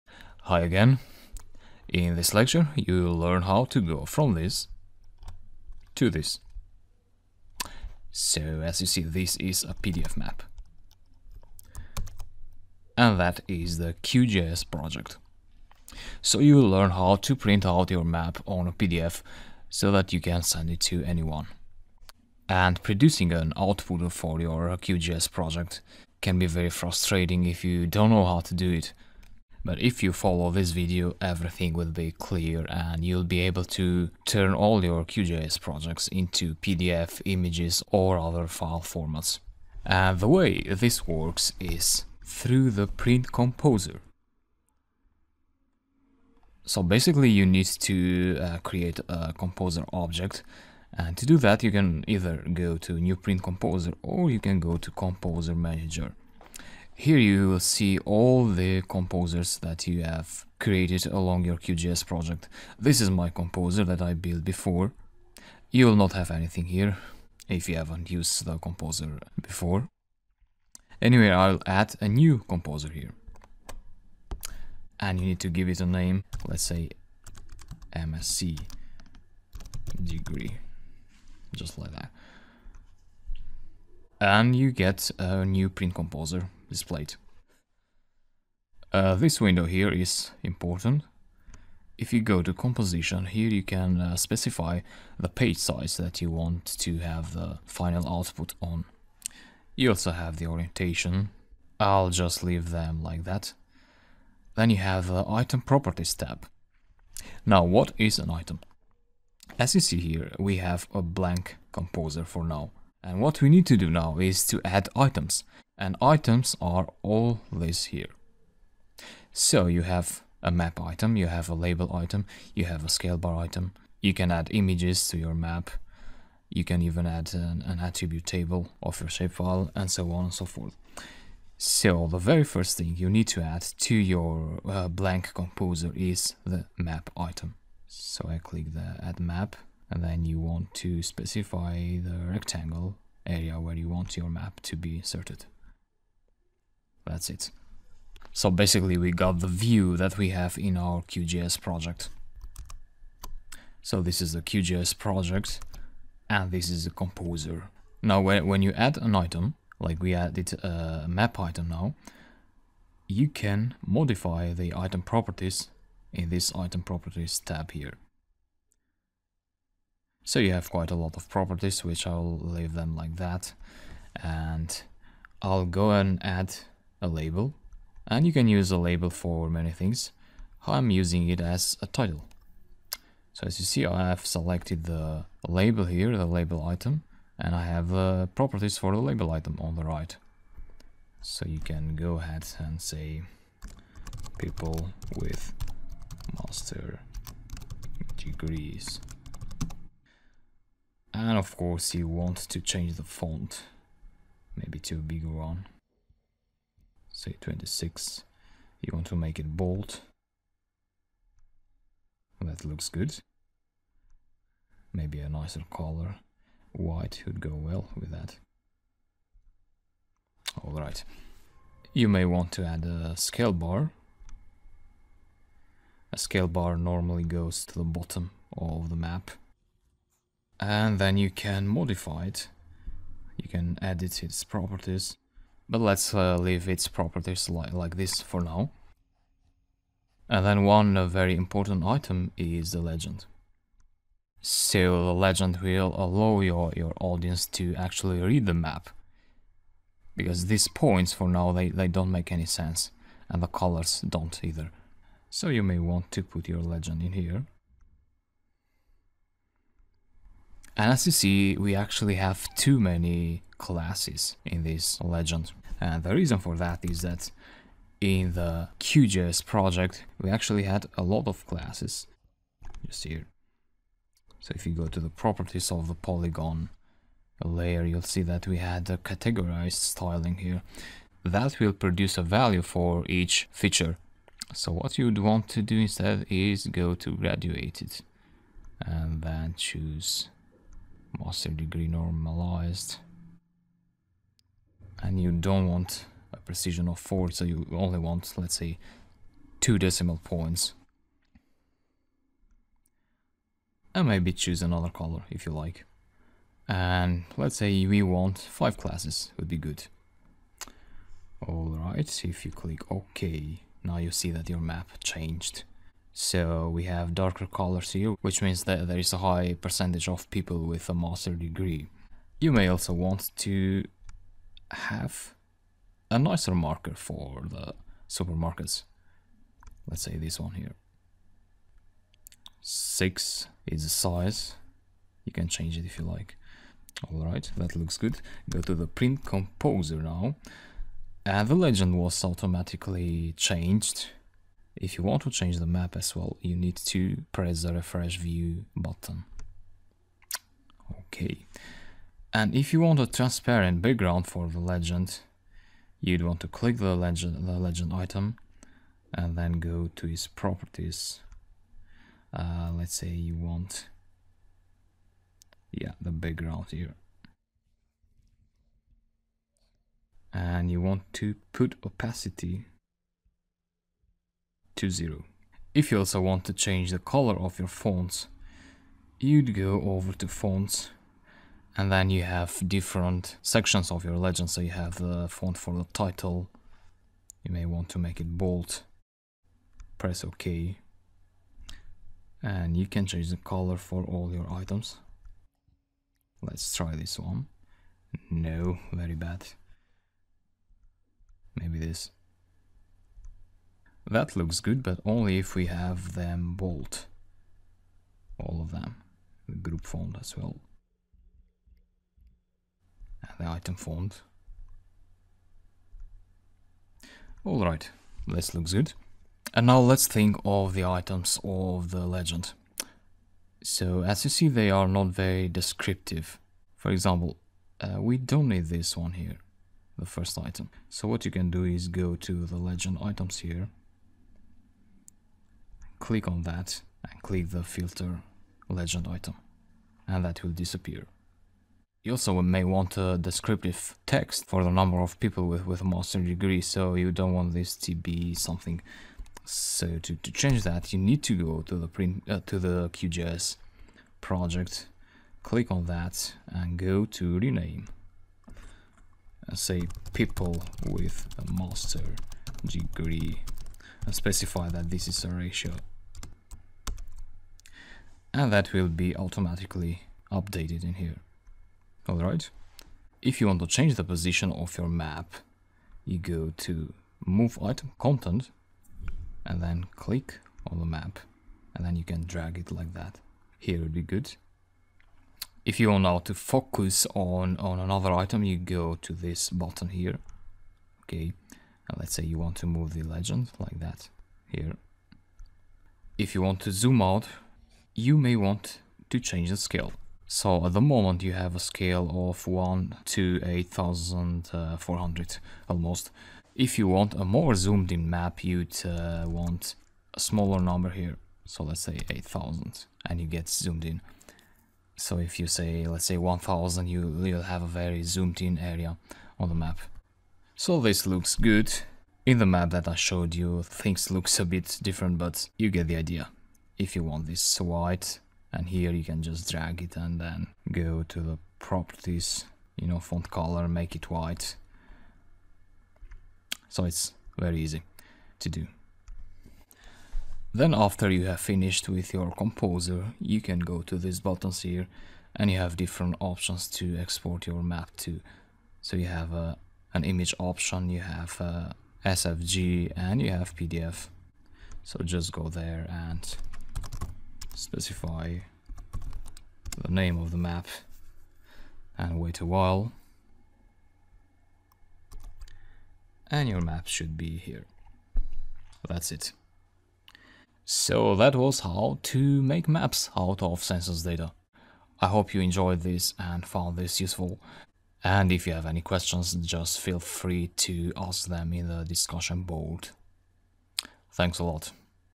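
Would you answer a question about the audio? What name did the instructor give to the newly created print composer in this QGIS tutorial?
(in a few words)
MSc degree.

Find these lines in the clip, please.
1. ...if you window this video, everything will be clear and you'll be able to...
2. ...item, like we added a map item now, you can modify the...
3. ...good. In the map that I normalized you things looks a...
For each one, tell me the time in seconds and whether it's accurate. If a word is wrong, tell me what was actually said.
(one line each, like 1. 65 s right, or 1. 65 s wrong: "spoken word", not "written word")
1. 29 s wrong: "follow", not "window"
2. 159 s right
3. 521 s wrong: "showed", not "normalized".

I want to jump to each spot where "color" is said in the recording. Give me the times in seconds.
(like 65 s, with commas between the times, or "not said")
215 s, 253 s, 304 s, 317 s, 376 s, 393 s, 533 s.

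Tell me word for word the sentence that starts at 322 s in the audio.
You may also want to have a nicer marker for the supermarkets.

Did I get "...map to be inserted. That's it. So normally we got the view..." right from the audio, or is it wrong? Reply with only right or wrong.
wrong.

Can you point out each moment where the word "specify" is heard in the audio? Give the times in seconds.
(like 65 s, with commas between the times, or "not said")
94 s, 141 s, 464 s, 557 s.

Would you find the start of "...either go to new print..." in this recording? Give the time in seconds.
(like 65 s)
52 s.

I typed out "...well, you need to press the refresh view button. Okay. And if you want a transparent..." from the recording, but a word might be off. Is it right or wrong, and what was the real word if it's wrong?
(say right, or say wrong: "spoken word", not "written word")
right.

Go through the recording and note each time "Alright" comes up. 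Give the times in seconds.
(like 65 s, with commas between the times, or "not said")
220 s, 311 s, 337 s, 417 s, 472 s.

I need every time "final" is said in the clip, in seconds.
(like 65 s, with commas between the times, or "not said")
97 s.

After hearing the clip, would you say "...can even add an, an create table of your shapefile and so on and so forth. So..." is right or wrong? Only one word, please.
wrong.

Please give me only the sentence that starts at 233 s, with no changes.
You can edit its properties but let's uh, leave its properties li like this for now.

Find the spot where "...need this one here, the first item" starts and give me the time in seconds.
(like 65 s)
428 s.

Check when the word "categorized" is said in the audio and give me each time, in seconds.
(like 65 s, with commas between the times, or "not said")
278 s.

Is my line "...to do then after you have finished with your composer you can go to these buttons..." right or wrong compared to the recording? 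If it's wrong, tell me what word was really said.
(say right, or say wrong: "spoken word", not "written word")
right.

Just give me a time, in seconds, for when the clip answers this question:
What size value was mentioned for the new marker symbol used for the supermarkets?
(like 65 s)
332 s.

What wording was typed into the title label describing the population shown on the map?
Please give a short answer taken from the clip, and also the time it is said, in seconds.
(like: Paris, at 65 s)
people with master degrees, at 194 s.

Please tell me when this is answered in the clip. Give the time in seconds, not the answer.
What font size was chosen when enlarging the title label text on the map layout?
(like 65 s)
207 s.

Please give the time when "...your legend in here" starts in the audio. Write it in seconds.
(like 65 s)
256 s.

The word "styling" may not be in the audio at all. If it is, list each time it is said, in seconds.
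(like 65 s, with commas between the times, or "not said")
279 s.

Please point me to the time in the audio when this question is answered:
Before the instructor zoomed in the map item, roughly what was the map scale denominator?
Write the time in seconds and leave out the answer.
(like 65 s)
503 s.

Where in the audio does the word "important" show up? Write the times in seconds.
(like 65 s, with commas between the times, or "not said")
90 s, 241 s.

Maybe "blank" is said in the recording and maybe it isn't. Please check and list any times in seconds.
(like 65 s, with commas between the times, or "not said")
111 s, 134 s.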